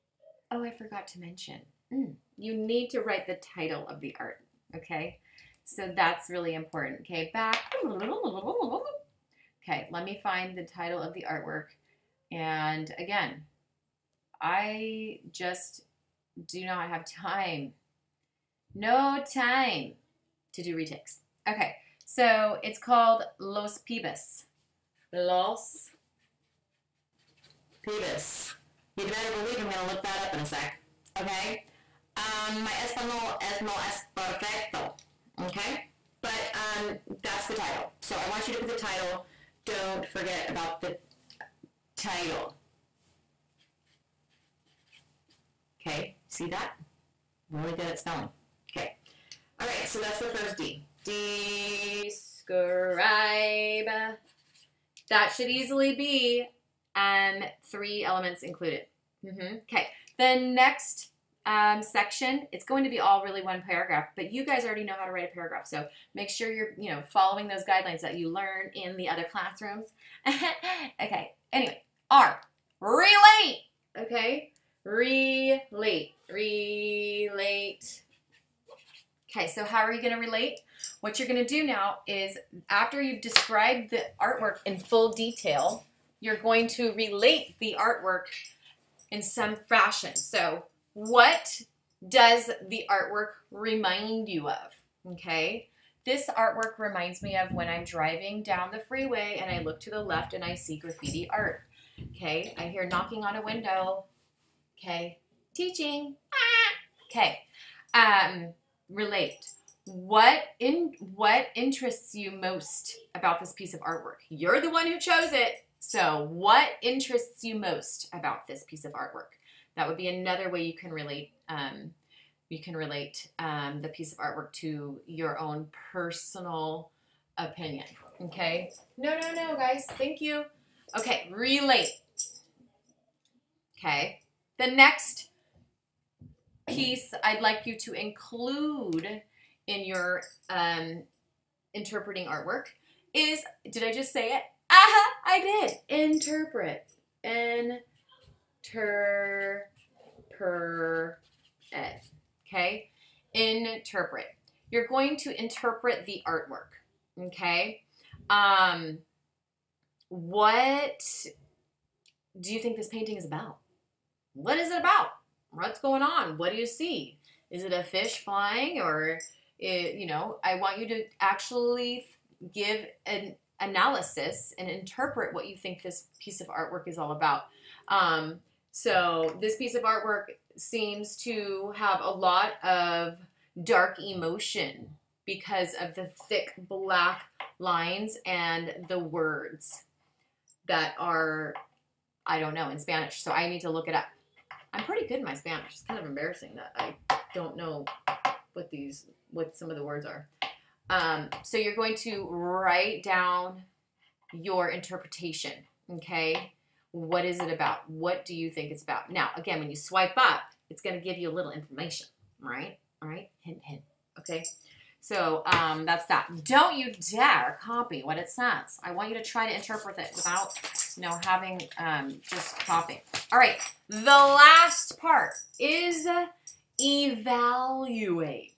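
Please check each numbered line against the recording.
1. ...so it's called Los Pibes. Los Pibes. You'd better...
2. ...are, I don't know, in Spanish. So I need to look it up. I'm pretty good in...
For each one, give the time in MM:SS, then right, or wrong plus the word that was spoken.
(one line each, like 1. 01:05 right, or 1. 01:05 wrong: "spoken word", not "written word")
1. 00:22 right
2. 03:10 right.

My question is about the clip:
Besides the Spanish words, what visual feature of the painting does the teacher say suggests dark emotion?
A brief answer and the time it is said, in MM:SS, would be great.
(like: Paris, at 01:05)
thick black lines, at 03:06.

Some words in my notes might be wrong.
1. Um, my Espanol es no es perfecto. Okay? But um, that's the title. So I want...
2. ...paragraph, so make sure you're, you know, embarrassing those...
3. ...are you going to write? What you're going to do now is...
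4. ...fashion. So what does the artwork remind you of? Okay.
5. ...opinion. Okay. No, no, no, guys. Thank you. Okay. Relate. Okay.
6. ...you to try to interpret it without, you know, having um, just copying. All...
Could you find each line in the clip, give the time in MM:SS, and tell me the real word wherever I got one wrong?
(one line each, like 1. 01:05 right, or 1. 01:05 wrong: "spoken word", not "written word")
1. 00:32 right
2. 01:05 wrong: "following", not "embarrassing"
3. 01:19 wrong: "relate", not "write"
4. 01:29 right
5. 02:07 right
6. 03:39 right.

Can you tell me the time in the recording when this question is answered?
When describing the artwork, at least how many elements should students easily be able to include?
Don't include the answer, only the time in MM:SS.
00:57.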